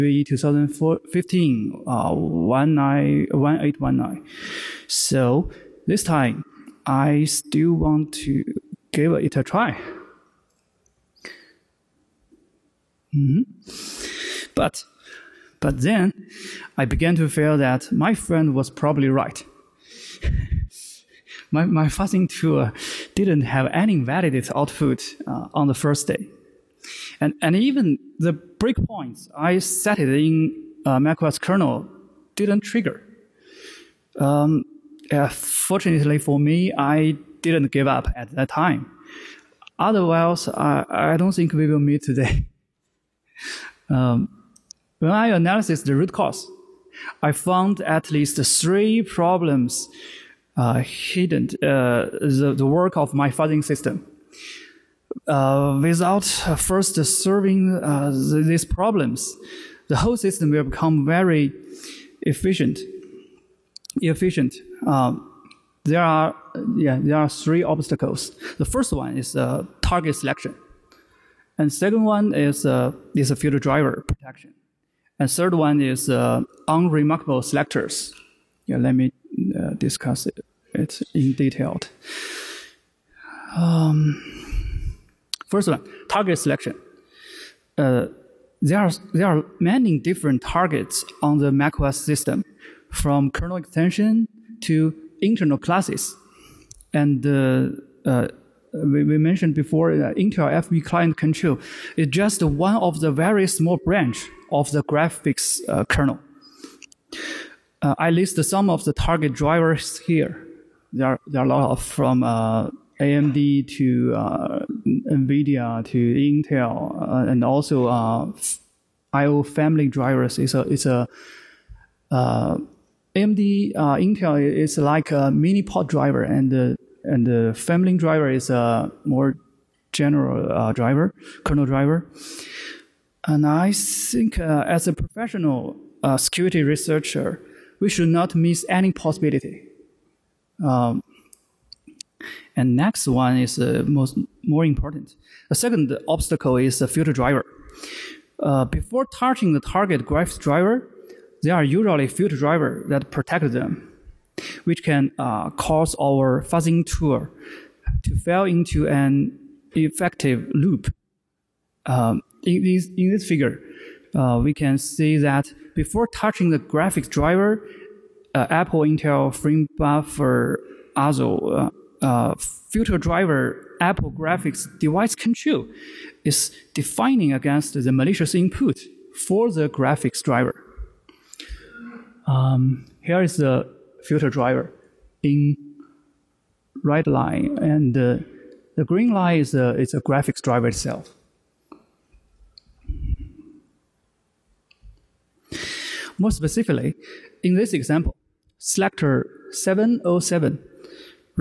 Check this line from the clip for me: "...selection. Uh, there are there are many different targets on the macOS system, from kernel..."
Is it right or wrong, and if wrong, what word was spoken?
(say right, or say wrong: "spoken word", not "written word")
right.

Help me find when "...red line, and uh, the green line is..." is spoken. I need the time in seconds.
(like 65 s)
186 s.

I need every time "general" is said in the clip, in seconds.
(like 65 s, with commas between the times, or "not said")
129 s.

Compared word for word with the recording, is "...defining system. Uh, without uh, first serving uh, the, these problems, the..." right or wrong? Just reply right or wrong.
wrong.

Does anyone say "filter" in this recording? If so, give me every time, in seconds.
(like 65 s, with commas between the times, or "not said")
146 s, 152 s, 172 s, 184 s.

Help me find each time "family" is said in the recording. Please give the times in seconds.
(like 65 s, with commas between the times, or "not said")
119 s, 127 s.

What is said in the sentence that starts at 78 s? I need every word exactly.
Yeah, let me uh, discuss it, in detail.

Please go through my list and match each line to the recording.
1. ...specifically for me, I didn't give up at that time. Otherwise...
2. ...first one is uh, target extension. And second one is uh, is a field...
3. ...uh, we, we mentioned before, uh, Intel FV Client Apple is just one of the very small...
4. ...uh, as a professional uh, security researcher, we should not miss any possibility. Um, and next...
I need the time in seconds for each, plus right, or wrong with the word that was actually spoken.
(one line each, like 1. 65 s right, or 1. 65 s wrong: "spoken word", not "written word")
1. 35 s wrong: "fortunately", not "specifically"
2. 68 s wrong: "selection", not "extension"
3. 98 s wrong: "Control", not "Apple"
4. 134 s right.